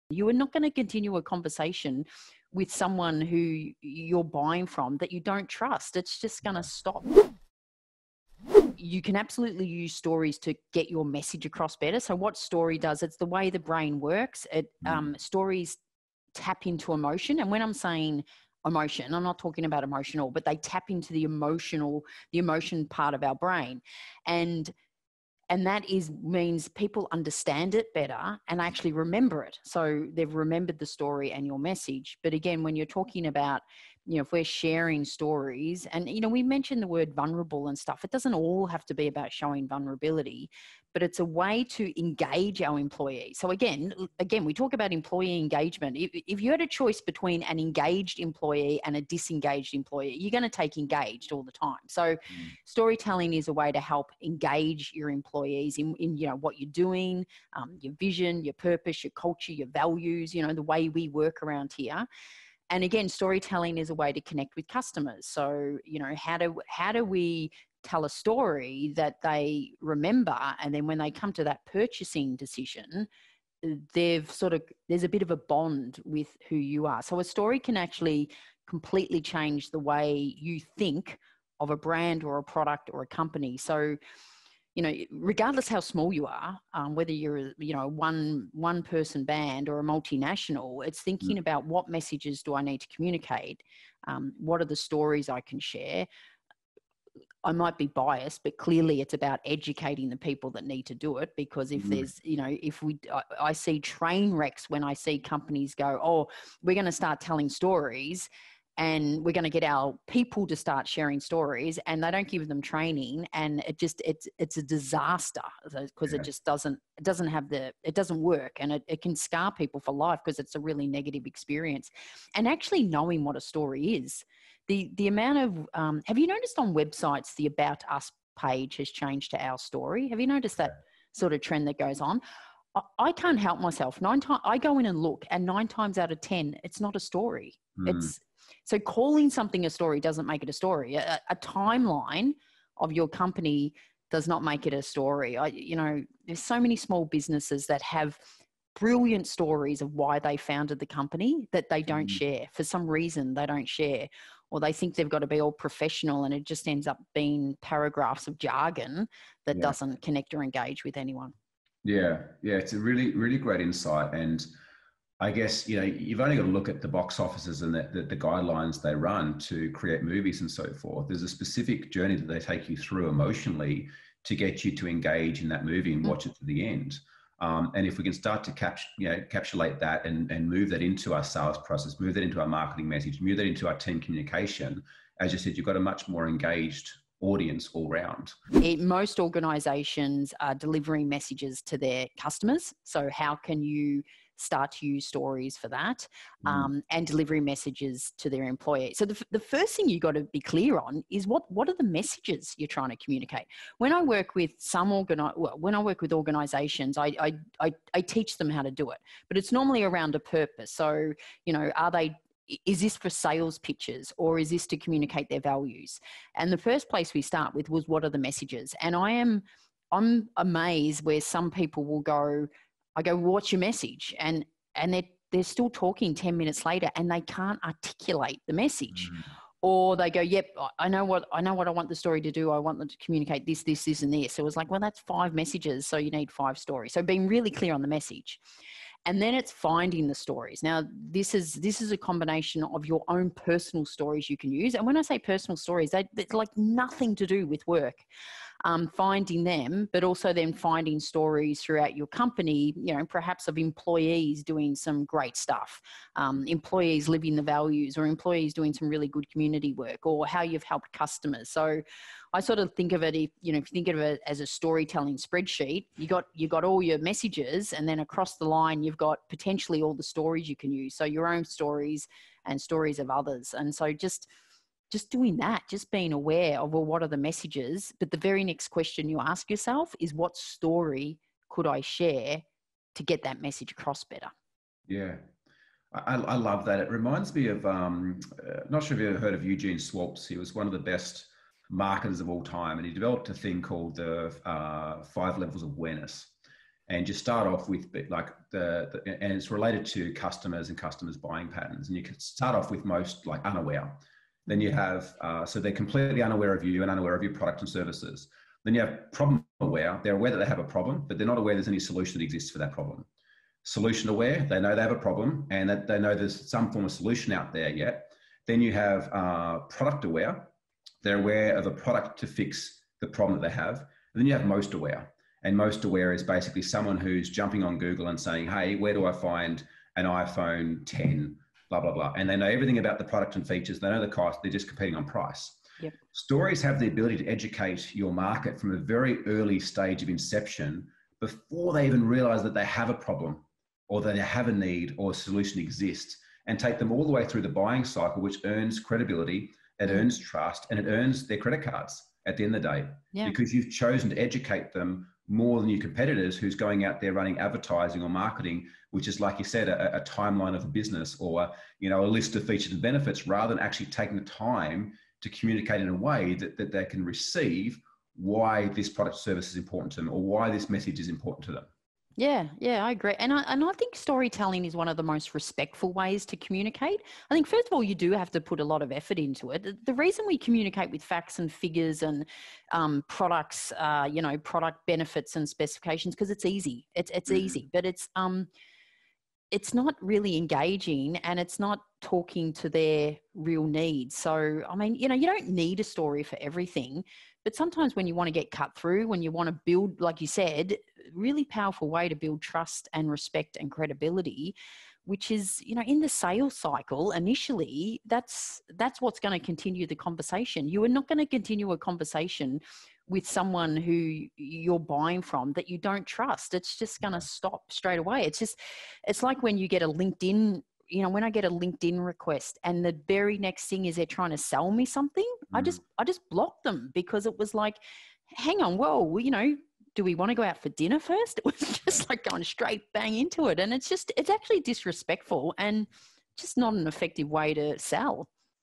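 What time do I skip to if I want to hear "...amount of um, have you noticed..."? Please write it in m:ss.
2:05.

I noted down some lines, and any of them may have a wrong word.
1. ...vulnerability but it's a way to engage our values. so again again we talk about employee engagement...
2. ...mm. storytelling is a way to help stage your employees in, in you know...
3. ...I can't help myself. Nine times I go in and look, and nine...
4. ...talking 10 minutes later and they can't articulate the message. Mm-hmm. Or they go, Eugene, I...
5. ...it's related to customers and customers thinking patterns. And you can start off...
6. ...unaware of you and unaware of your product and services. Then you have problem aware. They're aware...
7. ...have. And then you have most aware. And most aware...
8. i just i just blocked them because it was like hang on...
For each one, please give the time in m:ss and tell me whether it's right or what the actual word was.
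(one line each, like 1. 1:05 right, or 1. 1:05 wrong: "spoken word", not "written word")
1. 0:39 wrong: "employees", not "values"
2. 0:52 wrong: "engage", not "stage"
3. 2:12 right
4. 3:45 wrong: "Yep", not "Eugene"
5. 4:59 wrong: "buying", not "thinking"
6. 5:06 right
7. 5:23 right
8. 7:05 right.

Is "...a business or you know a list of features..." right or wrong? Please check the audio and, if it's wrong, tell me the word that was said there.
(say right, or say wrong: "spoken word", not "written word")
right.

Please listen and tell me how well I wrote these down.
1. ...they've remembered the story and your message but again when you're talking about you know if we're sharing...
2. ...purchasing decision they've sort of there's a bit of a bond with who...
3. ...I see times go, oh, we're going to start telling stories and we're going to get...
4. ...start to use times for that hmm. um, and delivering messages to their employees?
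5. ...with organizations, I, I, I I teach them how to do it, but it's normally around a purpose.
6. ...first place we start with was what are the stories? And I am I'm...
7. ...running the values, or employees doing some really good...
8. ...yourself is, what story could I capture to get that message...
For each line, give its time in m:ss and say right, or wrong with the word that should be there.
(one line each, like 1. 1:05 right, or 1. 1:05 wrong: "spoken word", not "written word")
1. 0:30 right
2. 1:11 right
3. 1:44 wrong: "companies", not "times"
4. 3:14 wrong: "stories", not "times"
5. 3:26 right
6. 3:36 wrong: "messages", not "stories"
7. 4:17 wrong: "living", not "running"
8. 4:39 wrong: "share", not "capture".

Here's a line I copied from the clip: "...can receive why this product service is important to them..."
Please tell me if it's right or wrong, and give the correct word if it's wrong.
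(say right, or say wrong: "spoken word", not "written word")
right.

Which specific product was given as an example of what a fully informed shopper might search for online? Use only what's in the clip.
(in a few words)
iPhone 10.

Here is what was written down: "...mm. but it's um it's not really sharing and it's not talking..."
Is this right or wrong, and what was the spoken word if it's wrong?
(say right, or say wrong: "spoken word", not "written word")
wrong: "engaging", not "sharing".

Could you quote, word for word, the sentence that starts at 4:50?
He was one of the best marketers of all time, and he developed a thing called the uh, five levels of awareness.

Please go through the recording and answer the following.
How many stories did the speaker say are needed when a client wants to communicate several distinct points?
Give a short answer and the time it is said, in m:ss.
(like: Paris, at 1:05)
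5, at 3:56.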